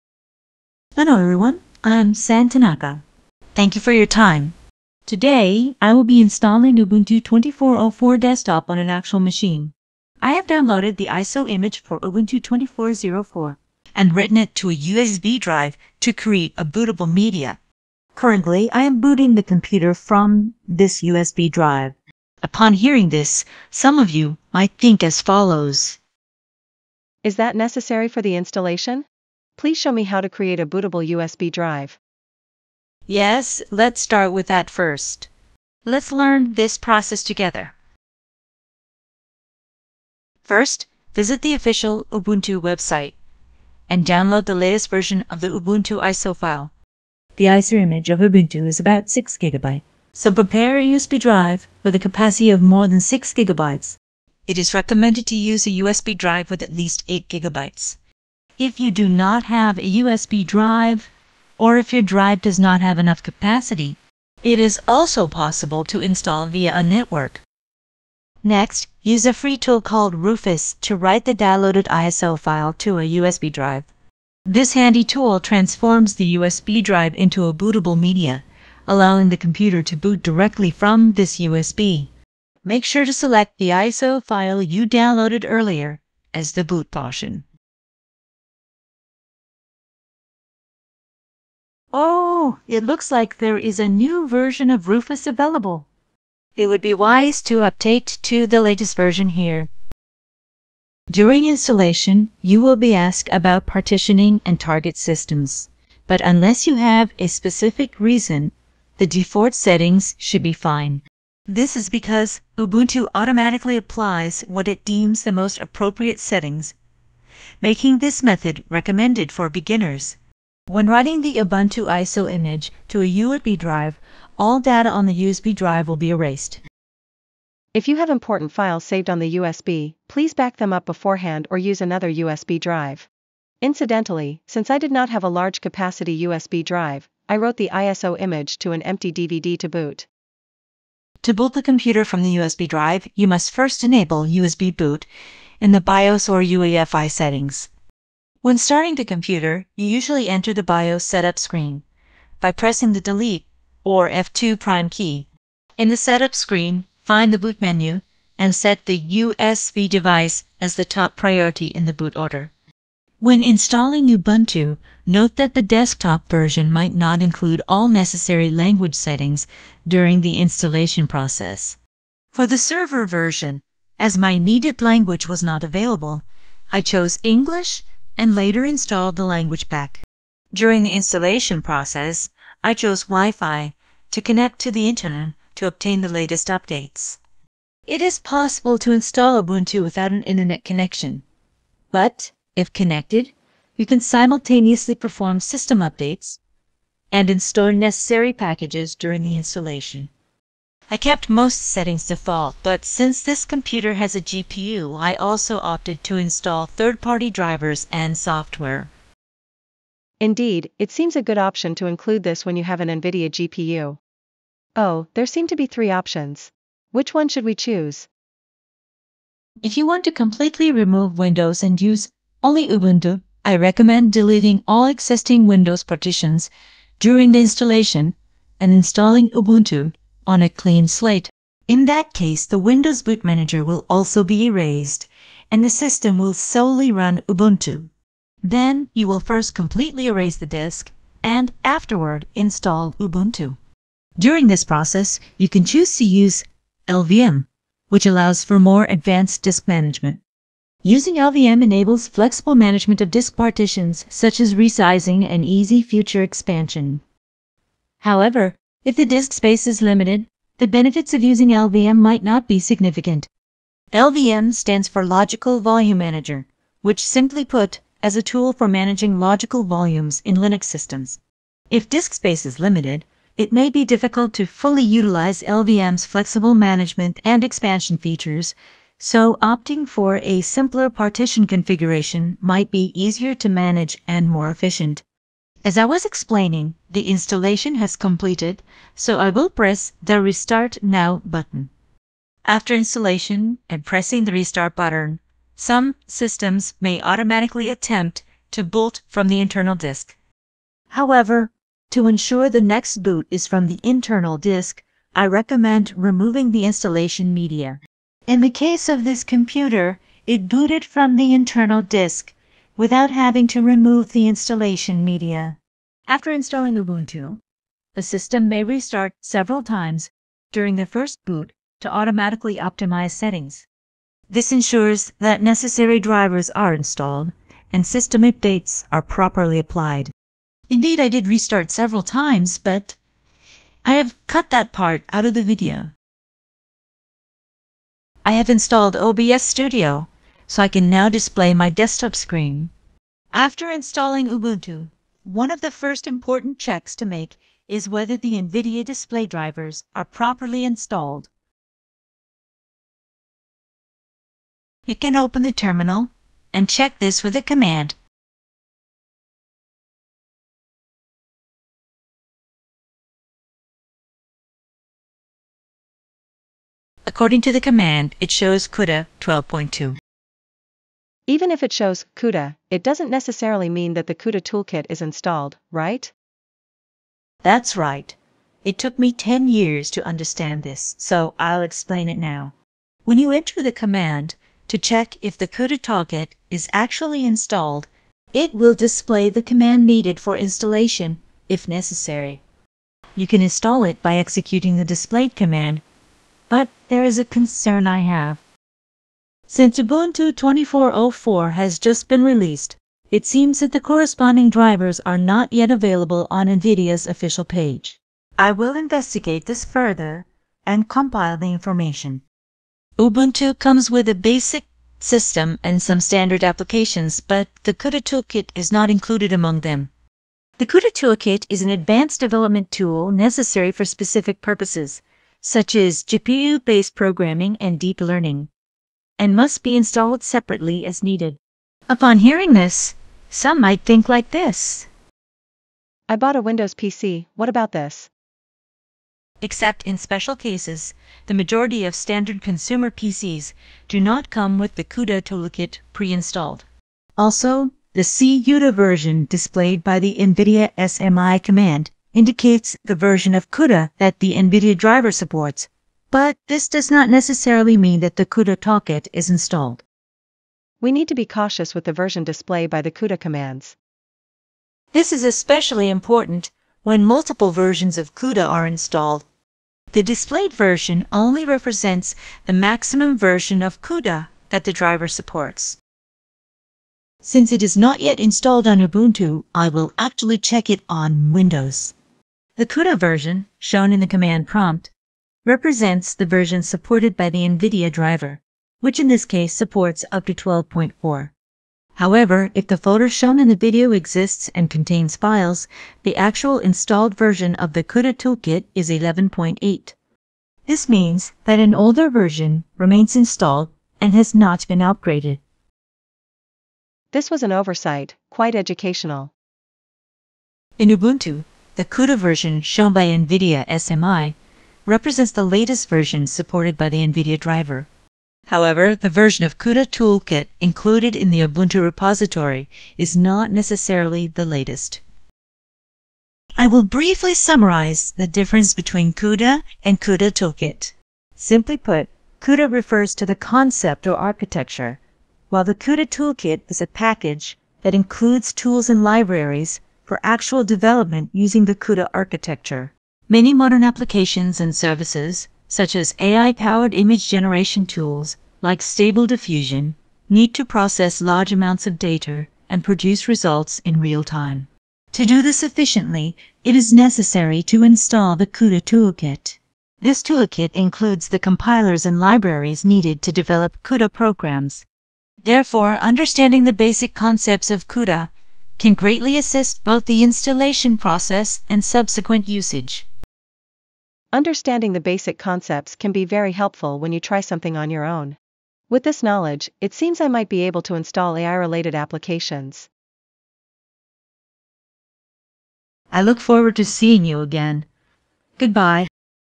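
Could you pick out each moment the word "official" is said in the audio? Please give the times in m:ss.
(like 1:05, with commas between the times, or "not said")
0:41, 6:47.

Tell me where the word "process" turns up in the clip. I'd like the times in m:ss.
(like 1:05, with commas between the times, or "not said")
0:36, 2:51, 3:01, 4:04, 9:10, 9:30.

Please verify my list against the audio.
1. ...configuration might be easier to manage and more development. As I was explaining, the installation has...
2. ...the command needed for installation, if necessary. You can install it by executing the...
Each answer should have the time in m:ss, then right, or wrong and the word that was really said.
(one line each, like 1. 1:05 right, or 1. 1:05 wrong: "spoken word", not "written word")
1. 4:41 wrong: "efficient", not "development"
2. 6:29 right.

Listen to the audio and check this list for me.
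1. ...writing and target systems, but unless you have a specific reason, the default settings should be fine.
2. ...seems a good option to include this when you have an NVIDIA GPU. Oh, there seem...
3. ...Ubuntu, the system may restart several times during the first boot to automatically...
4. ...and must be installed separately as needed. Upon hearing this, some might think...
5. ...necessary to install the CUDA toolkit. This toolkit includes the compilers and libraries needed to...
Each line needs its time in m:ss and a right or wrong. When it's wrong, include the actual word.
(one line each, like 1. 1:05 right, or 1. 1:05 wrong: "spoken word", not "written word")
1. 1:43 wrong: "partitioning", not "writing"
2. 3:30 right
3. 5:16 right
4. 7:09 right
5. 9:16 right.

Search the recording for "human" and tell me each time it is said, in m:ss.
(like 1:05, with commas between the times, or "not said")
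not said.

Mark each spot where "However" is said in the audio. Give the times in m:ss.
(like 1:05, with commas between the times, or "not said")
4:17, 5:00, 8:11, 8:38.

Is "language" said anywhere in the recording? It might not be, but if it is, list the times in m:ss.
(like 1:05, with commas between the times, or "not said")
2:48, 2:54, 2:59.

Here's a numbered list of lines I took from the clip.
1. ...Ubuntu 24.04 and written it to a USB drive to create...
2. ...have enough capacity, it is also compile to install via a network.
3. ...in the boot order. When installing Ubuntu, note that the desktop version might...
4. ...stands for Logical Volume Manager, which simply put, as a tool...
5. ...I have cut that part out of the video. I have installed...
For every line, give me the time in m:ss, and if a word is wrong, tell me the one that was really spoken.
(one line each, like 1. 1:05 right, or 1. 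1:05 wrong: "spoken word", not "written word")
1. 0:12 right
2. 1:02 wrong: "possible", not "compile"
3. 2:41 right
4. 4:24 right
5. 5:33 right.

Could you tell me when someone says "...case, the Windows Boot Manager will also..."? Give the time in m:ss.
3:52.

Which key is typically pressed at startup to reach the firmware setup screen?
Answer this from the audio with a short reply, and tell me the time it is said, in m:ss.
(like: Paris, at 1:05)
Delete or F2, at 2:32.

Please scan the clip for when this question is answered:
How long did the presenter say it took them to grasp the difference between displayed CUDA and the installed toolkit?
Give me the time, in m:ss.
6:19.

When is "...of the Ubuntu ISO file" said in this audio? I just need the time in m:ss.
0:45.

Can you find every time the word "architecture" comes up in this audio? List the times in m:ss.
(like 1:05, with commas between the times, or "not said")
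8:54, 9:02.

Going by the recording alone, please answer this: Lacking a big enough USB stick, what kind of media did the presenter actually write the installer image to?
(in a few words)
DVD.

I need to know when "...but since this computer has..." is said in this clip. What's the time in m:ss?
3:22.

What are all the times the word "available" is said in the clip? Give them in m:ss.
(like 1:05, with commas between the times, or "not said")
1:35, 2:55, 6:45.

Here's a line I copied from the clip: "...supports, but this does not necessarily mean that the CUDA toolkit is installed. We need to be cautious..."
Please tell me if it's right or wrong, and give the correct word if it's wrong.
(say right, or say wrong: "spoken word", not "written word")
right.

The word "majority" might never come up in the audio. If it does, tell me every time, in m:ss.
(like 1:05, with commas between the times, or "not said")
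7:21.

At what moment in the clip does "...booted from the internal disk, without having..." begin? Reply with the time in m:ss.
5:10.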